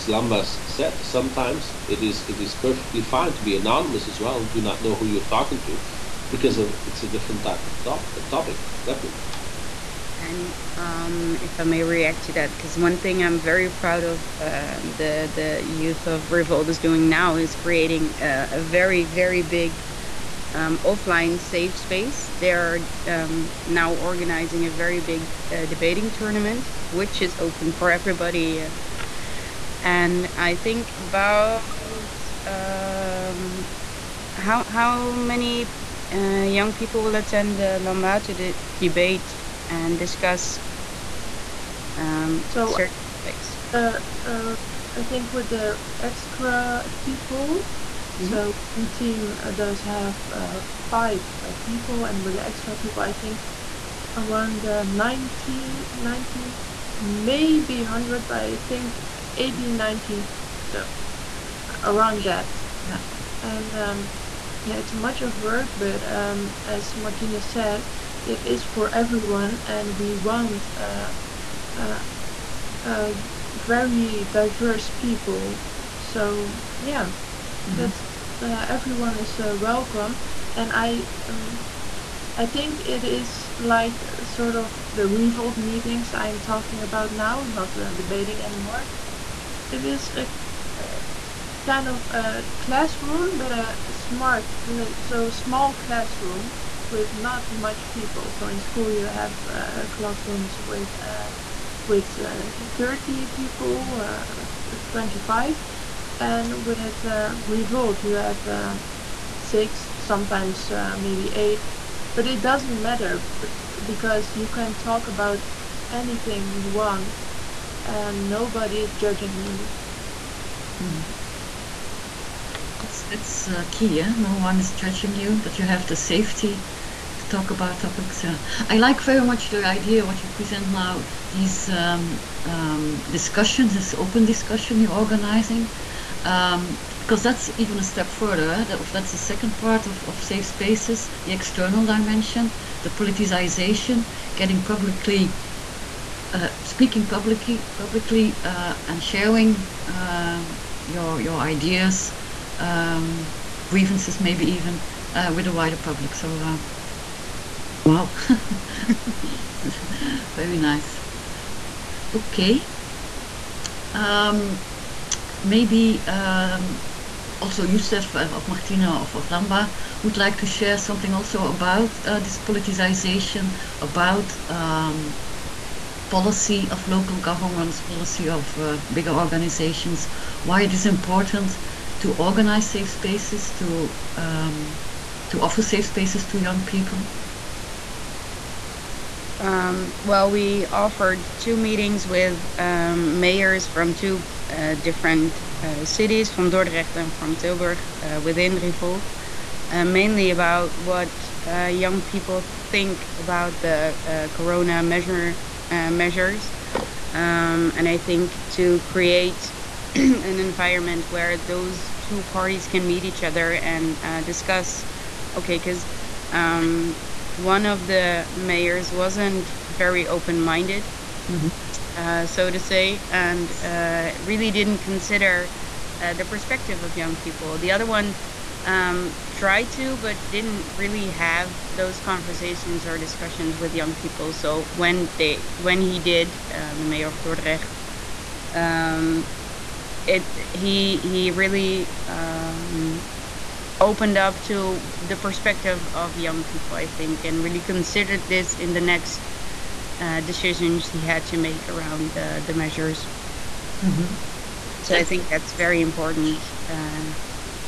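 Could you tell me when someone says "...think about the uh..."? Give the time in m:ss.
3:22.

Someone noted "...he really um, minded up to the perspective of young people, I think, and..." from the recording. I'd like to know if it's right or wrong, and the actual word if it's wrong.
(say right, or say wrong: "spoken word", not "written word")
wrong: "opened", not "minded".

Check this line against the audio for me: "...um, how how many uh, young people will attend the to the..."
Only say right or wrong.
right.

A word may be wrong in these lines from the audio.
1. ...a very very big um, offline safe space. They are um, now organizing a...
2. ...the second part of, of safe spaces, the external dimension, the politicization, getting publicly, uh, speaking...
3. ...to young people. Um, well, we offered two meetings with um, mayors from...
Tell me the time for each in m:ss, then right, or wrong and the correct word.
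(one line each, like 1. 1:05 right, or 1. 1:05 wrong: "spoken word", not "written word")
1. 0:18 right
2. 2:19 right
3. 3:06 right.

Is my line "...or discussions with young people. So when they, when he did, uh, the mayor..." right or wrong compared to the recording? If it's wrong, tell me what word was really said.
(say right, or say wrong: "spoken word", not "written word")
right.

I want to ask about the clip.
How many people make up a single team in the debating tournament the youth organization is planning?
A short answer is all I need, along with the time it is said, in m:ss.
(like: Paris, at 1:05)
5, at 0:50.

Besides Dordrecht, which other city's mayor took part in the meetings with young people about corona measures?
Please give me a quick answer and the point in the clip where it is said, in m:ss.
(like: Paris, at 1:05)
Tilburg, at 3:17.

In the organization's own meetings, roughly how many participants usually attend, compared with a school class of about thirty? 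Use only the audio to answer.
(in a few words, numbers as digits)
6.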